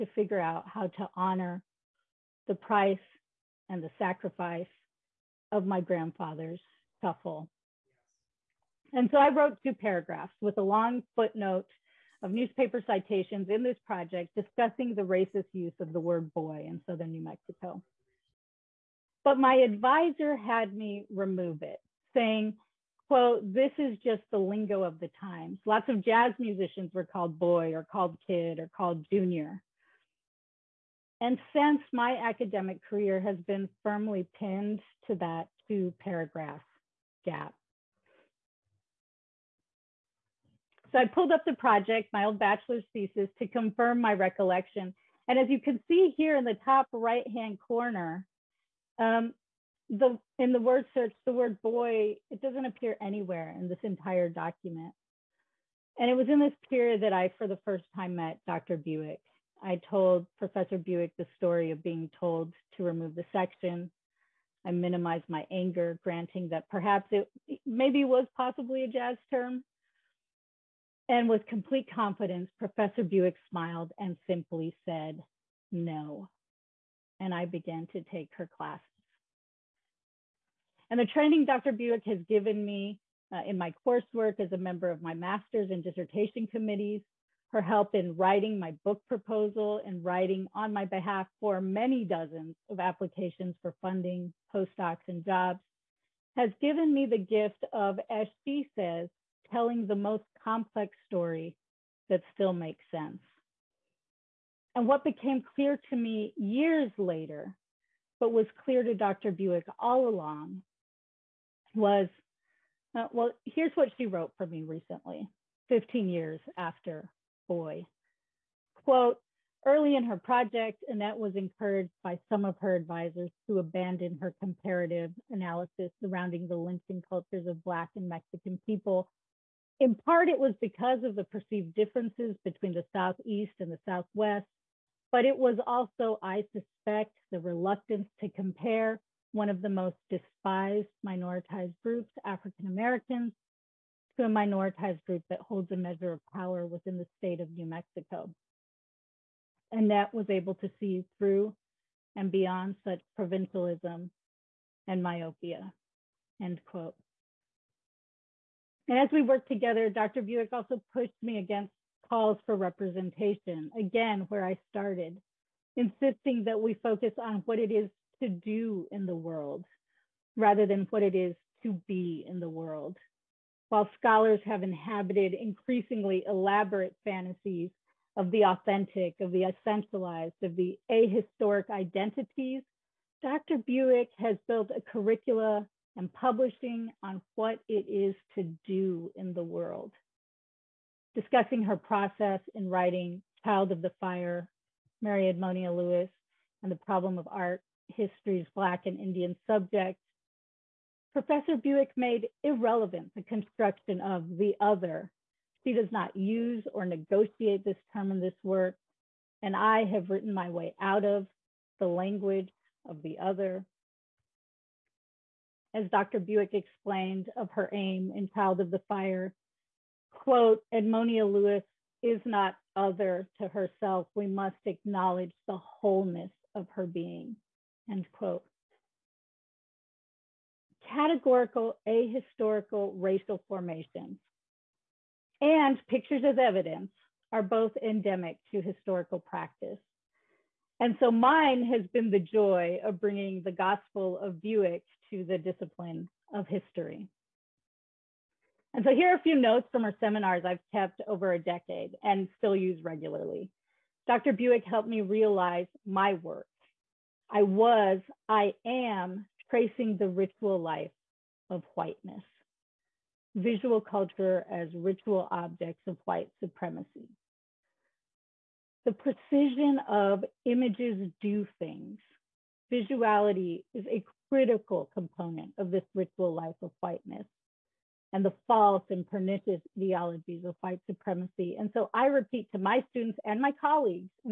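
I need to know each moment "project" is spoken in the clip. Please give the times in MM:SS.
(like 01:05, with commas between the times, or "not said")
00:13, 00:41, 02:00.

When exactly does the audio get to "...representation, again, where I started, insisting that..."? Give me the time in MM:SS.
02:42.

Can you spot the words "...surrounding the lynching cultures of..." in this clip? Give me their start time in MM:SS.
02:06.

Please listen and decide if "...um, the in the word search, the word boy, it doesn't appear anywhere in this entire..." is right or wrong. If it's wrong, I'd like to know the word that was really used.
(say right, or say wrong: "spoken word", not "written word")
right.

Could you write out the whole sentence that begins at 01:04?
I minimized my anger, granting that perhaps it maybe was possibly a jazz term.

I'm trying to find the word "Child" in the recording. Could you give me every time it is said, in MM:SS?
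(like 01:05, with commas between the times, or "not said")
03:13, 03:38.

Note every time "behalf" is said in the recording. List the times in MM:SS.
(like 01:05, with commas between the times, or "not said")
01:30.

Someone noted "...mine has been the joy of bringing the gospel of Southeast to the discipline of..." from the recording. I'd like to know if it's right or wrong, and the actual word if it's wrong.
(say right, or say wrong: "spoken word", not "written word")
wrong: "Buick", not "Southeast".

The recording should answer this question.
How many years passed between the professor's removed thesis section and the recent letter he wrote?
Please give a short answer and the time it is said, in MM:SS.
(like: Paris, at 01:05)
15, at 01:55.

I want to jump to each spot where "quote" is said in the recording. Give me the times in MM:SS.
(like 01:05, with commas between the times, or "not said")
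00:23, 01:58, 02:36, 03:40, 03:48.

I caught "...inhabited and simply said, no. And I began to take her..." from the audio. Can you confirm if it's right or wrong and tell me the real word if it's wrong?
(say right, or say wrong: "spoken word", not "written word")
wrong: "smiled", not "inhabited".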